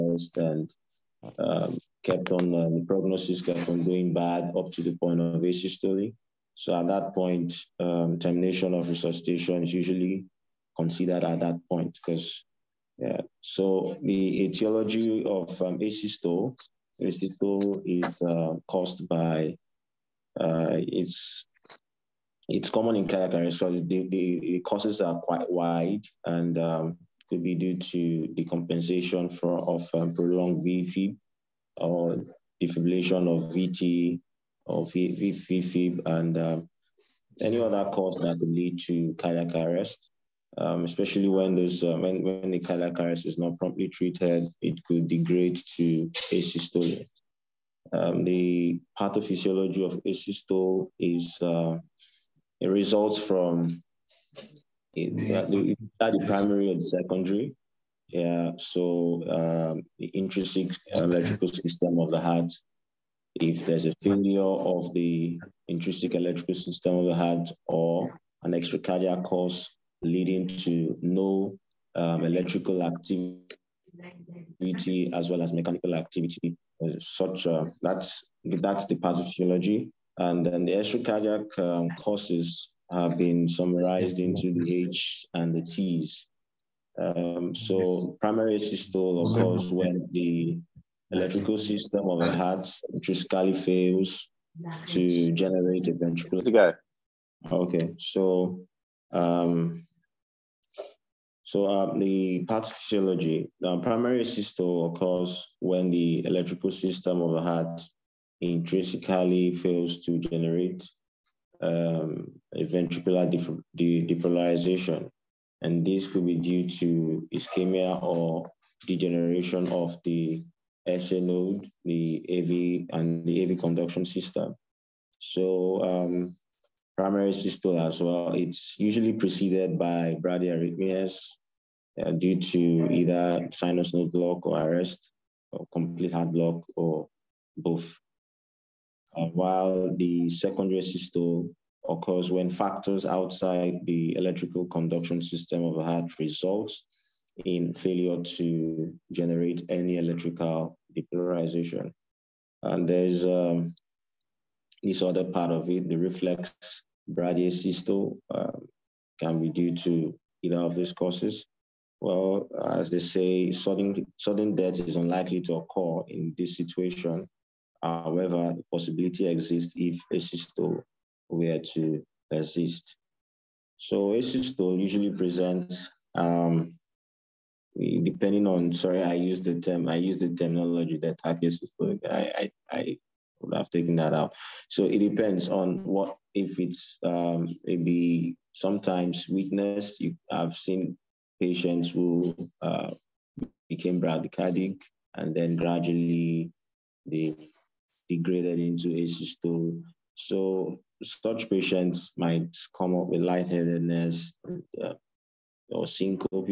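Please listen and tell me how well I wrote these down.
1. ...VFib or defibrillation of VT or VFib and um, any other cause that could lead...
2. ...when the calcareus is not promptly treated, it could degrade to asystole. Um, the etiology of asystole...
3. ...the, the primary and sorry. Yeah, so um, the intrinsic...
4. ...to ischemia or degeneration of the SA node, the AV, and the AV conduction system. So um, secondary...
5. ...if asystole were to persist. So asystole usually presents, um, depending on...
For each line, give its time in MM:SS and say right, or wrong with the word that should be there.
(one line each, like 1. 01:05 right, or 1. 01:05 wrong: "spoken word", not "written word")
1. 00:30 right
2. 00:42 wrong: "pathophysiology", not "etiology"
3. 00:55 wrong: "secondary", not "sorry"
4. 01:56 wrong: "primary", not "secondary"
5. 02:49 right.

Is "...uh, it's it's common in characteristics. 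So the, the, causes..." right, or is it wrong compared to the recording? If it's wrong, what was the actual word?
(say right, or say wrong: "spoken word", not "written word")
right.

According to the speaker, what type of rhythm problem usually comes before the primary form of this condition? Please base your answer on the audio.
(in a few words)
Bradyarrhythmias.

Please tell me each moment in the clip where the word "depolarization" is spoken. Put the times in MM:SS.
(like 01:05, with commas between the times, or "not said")
01:53, 02:30.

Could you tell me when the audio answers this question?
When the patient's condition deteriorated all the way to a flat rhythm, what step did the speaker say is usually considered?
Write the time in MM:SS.
00:08.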